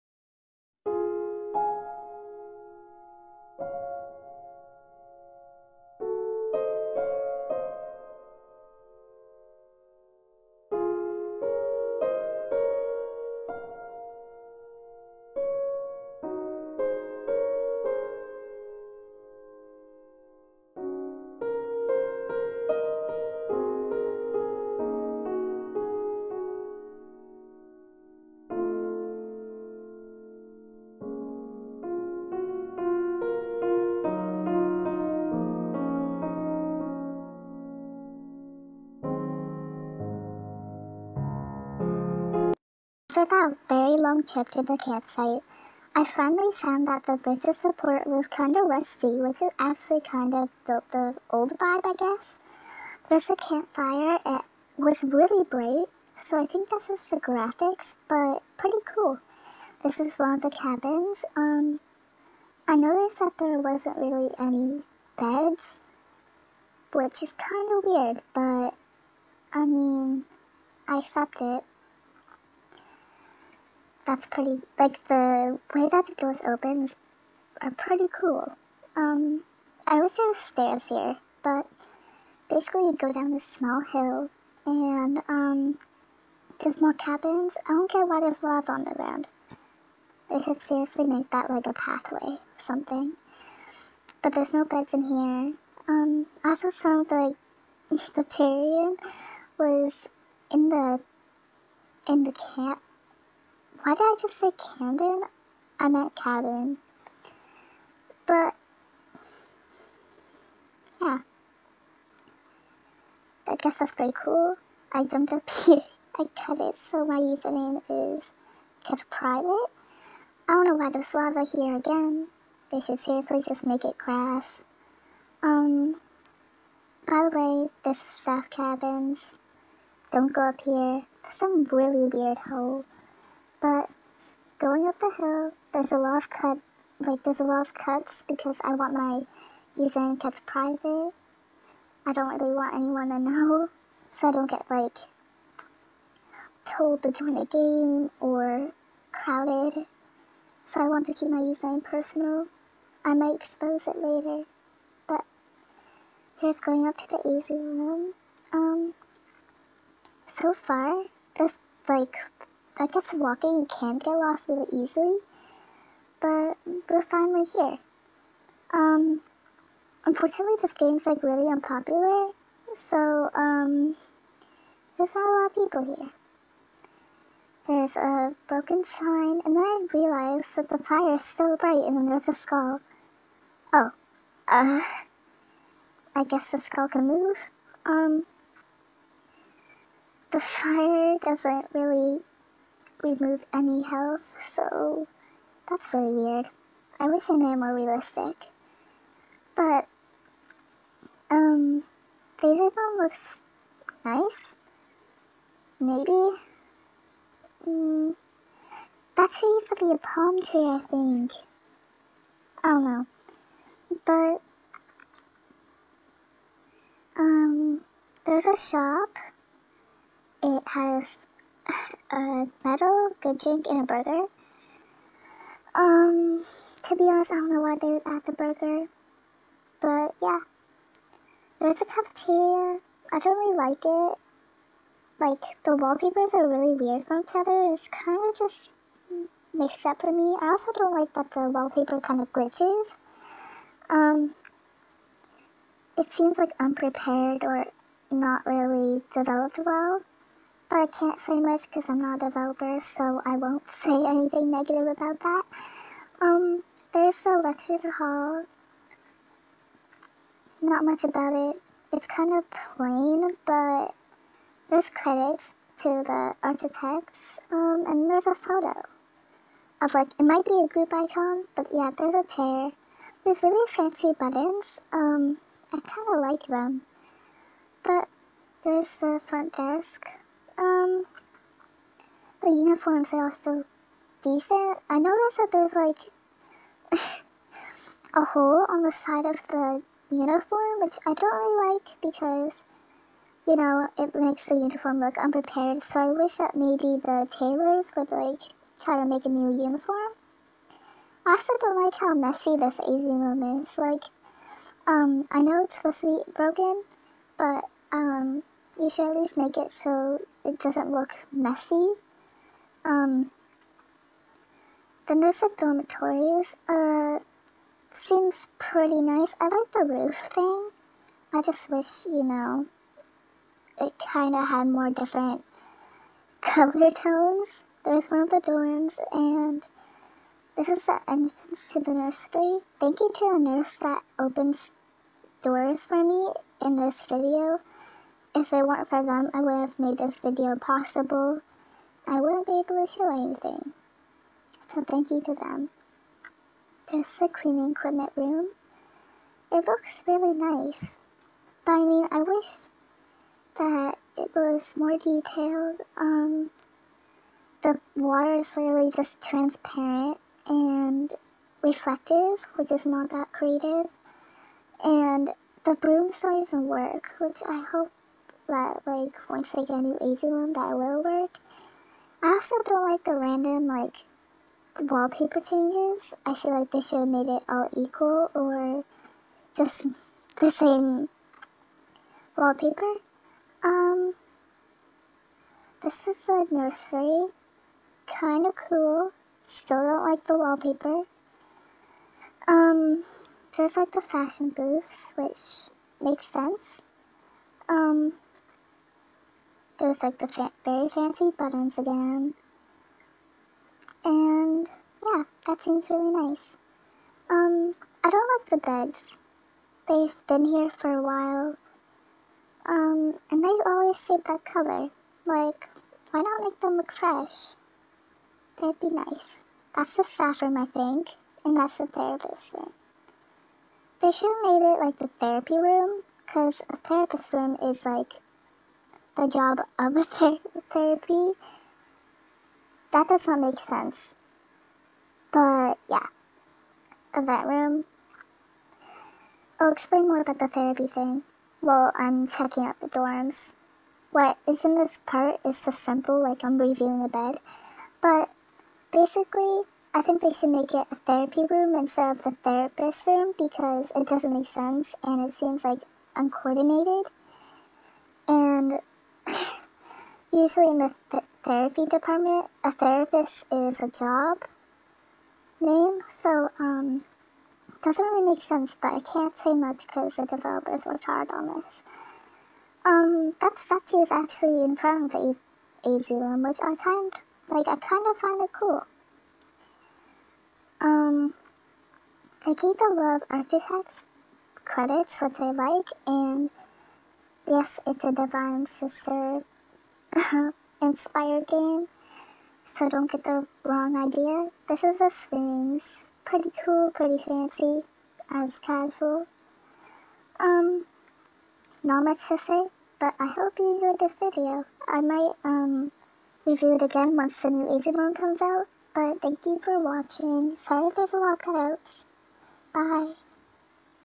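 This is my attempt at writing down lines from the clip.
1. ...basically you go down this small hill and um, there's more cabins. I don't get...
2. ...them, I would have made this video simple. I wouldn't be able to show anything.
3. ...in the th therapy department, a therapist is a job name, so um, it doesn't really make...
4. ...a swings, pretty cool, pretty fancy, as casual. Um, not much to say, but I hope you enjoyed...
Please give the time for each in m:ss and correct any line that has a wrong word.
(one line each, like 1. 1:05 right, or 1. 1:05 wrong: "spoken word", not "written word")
1. 1:22 right
2. 5:39 wrong: "possible", not "simple"
3. 7:40 right
4. 8:14 right.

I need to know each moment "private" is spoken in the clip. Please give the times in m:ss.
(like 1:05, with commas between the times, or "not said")
1:59, 2:20.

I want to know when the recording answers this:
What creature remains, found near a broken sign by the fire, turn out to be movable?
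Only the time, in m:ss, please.
3:02.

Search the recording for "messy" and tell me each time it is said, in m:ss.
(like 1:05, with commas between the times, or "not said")
5:02, 5:11.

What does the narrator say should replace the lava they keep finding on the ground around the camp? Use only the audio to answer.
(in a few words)
Grass.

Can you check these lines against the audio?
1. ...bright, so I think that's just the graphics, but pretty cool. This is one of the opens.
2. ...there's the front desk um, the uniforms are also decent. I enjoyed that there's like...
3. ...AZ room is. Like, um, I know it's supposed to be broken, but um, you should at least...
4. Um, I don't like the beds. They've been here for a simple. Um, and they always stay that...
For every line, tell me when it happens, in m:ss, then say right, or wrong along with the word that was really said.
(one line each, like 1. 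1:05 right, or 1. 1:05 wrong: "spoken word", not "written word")
1. 0:55 wrong: "cabins", not "opens"
2. 4:38 wrong: "noticed", not "enjoyed"
3. 5:02 right
4. 6:47 wrong: "while", not "simple".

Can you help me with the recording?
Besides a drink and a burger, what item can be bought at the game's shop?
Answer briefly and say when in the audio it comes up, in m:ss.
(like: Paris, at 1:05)
A metal, at 3:40.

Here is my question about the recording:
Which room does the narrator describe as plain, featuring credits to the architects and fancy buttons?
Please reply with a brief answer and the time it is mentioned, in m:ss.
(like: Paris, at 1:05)
Lecture hall, at 4:17.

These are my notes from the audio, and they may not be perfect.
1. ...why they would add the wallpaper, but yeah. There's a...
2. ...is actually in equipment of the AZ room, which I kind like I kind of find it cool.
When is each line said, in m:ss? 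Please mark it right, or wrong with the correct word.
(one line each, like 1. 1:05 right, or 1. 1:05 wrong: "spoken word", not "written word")
1. 3:47 wrong: "burger", not "wallpaper"
2. 7:54 wrong: "front", not "equipment".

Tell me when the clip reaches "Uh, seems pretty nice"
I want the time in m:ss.
5:16.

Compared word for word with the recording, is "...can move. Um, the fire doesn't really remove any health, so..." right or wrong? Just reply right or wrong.
right.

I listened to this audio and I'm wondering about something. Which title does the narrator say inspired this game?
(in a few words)
Divine Sister.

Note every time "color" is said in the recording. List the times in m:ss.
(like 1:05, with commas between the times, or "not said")
5:26, 6:54.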